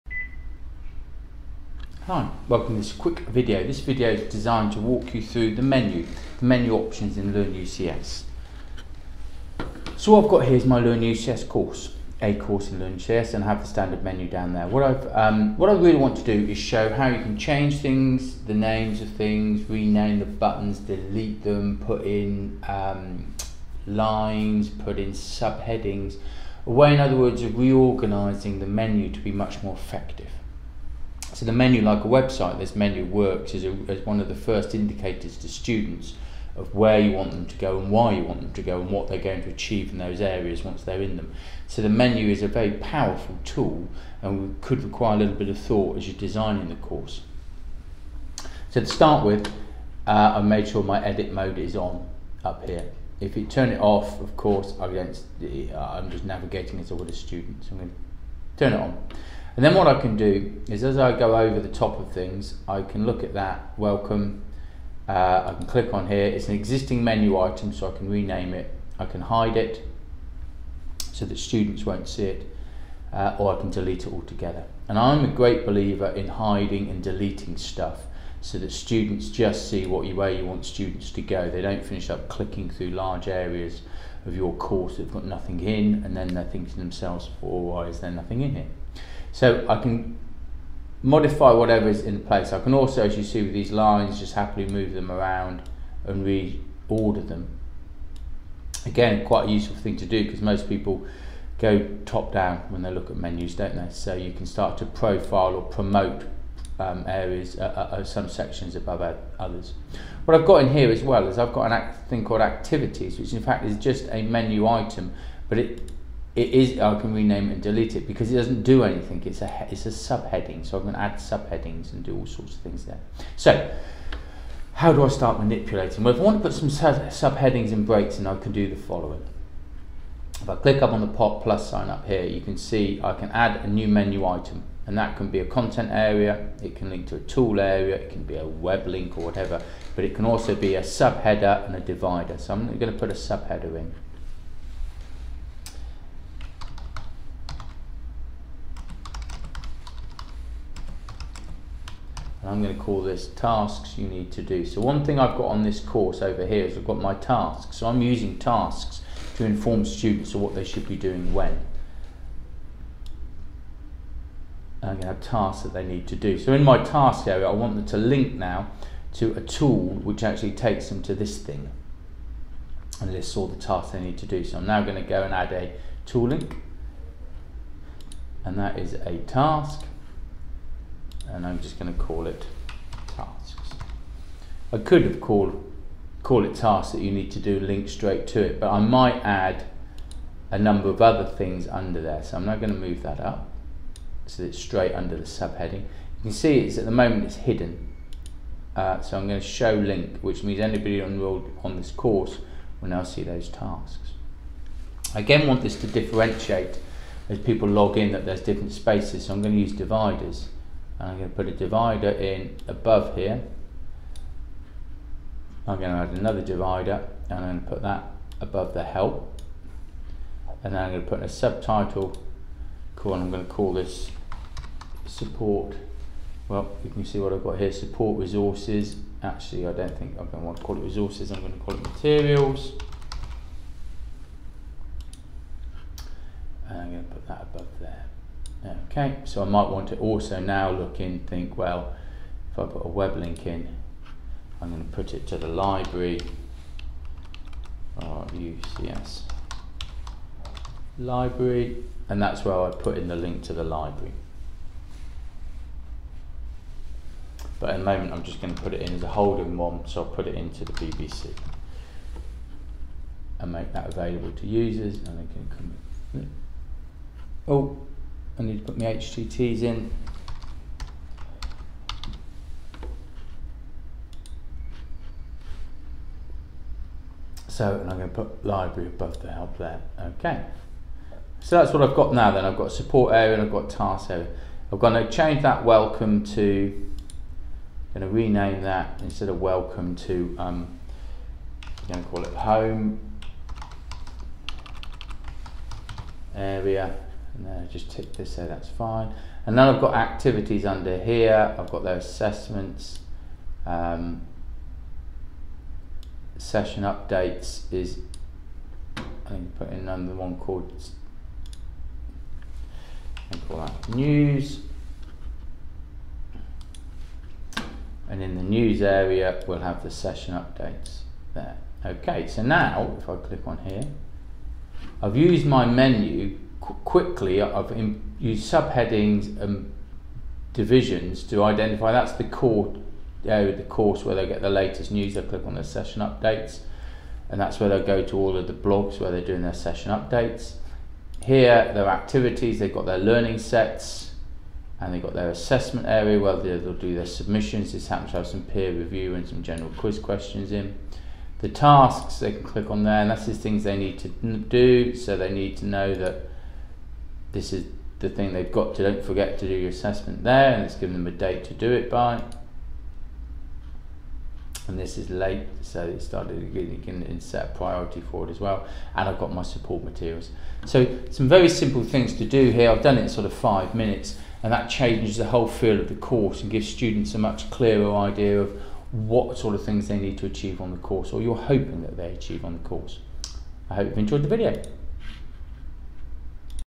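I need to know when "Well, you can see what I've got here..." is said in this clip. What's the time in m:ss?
3:46.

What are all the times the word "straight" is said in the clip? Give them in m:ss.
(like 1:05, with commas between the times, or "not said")
3:07, 3:14.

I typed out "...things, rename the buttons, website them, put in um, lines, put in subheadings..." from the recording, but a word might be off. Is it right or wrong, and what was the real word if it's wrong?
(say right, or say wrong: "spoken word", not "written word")
wrong: "delete", not "website".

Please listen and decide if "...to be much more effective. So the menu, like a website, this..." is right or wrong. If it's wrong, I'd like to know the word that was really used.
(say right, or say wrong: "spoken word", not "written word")
right.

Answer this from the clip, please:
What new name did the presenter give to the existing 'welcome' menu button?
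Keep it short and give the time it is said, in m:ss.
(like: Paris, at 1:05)
Home area, at 4:52.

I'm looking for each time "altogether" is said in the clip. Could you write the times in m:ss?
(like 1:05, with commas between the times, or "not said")
1:14.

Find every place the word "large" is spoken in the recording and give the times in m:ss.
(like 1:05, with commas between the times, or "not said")
1:22.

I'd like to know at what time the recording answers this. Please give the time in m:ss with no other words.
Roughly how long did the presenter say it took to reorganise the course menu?
6:13.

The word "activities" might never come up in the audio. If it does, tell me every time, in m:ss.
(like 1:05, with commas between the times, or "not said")
1:52, 4:59, 5:41.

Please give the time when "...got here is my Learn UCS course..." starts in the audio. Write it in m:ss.
0:10.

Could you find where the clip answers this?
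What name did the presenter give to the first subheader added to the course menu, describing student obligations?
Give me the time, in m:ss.
2:33.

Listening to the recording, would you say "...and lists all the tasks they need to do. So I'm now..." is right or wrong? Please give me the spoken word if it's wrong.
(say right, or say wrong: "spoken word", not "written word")
right.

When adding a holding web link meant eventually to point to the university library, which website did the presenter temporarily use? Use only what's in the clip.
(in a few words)
BBC.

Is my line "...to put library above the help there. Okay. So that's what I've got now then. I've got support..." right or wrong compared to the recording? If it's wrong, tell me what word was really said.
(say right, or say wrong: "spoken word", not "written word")
right.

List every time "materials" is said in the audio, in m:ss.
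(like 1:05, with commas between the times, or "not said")
3:51, 6:09.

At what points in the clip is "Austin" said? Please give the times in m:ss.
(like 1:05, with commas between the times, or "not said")
not said.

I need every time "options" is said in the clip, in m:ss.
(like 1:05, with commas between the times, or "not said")
0:06.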